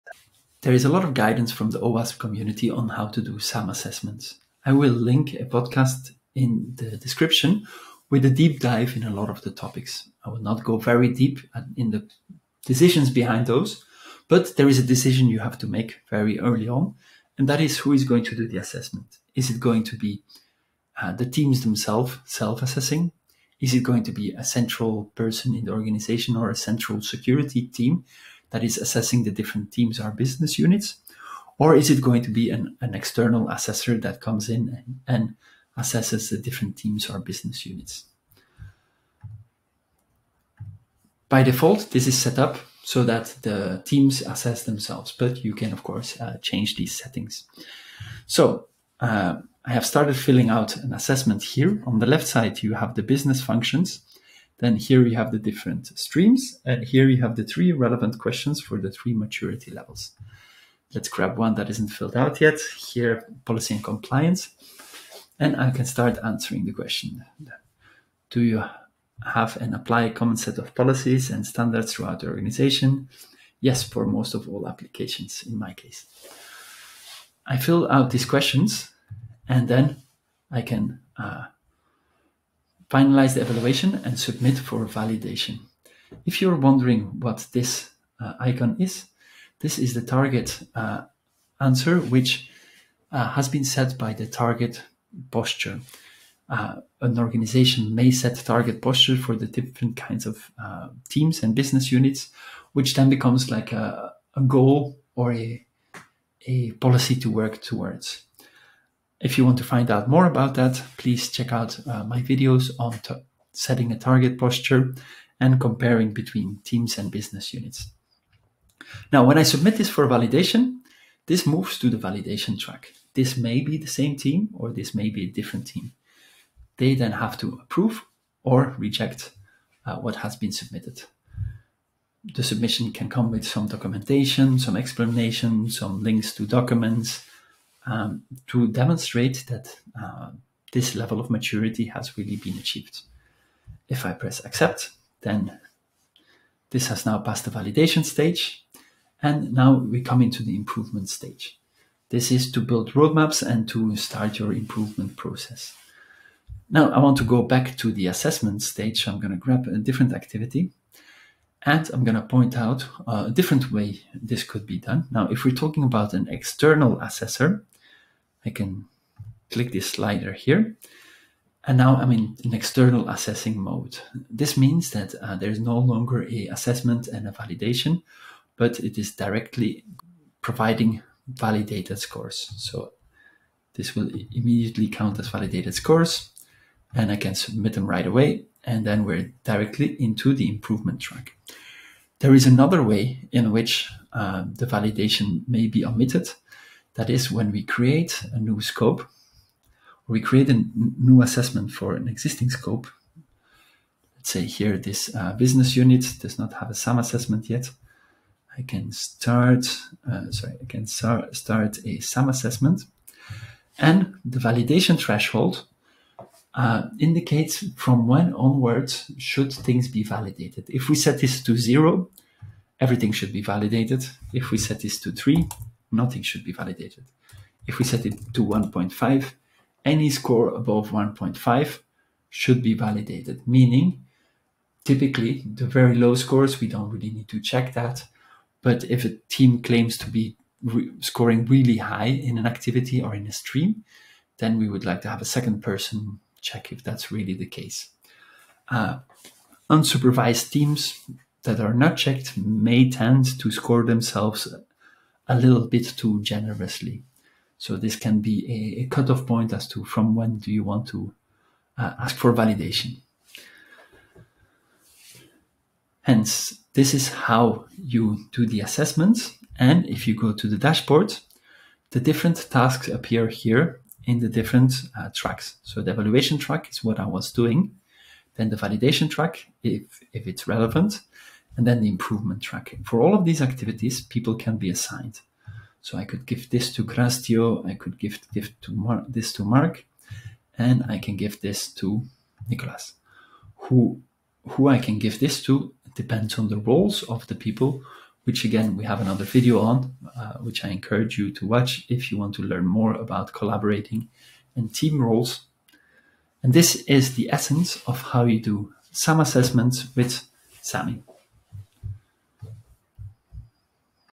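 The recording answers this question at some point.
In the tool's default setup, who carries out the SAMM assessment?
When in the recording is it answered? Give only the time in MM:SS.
00:43.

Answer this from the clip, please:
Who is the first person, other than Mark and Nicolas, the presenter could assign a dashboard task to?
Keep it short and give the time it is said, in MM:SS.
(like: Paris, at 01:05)
Grastio, at 04:46.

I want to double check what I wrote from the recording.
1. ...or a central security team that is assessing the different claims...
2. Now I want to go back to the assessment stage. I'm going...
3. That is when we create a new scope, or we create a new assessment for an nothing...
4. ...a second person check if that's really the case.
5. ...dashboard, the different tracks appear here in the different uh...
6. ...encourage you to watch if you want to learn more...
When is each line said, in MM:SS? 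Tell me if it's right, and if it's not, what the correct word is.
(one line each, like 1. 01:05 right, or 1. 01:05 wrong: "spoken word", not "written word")
1. 00:26 wrong: "teams", not "claims"
2. 02:36 right
3. 03:16 wrong: "existing", not "nothing"
4. 04:05 right
5. 04:30 wrong: "tasks", not "tracks"
6. 05:00 right.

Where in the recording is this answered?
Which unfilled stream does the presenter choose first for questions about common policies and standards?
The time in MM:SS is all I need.
01:03.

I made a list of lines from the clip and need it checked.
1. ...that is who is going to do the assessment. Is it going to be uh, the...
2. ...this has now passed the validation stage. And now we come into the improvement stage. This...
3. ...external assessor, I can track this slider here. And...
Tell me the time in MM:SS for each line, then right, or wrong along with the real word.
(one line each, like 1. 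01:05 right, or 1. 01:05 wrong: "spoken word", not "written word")
1. 00:17 right
2. 02:26 right
3. 02:46 wrong: "click", not "track".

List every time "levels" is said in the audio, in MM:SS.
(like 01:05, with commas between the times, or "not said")
00:59, 02:20.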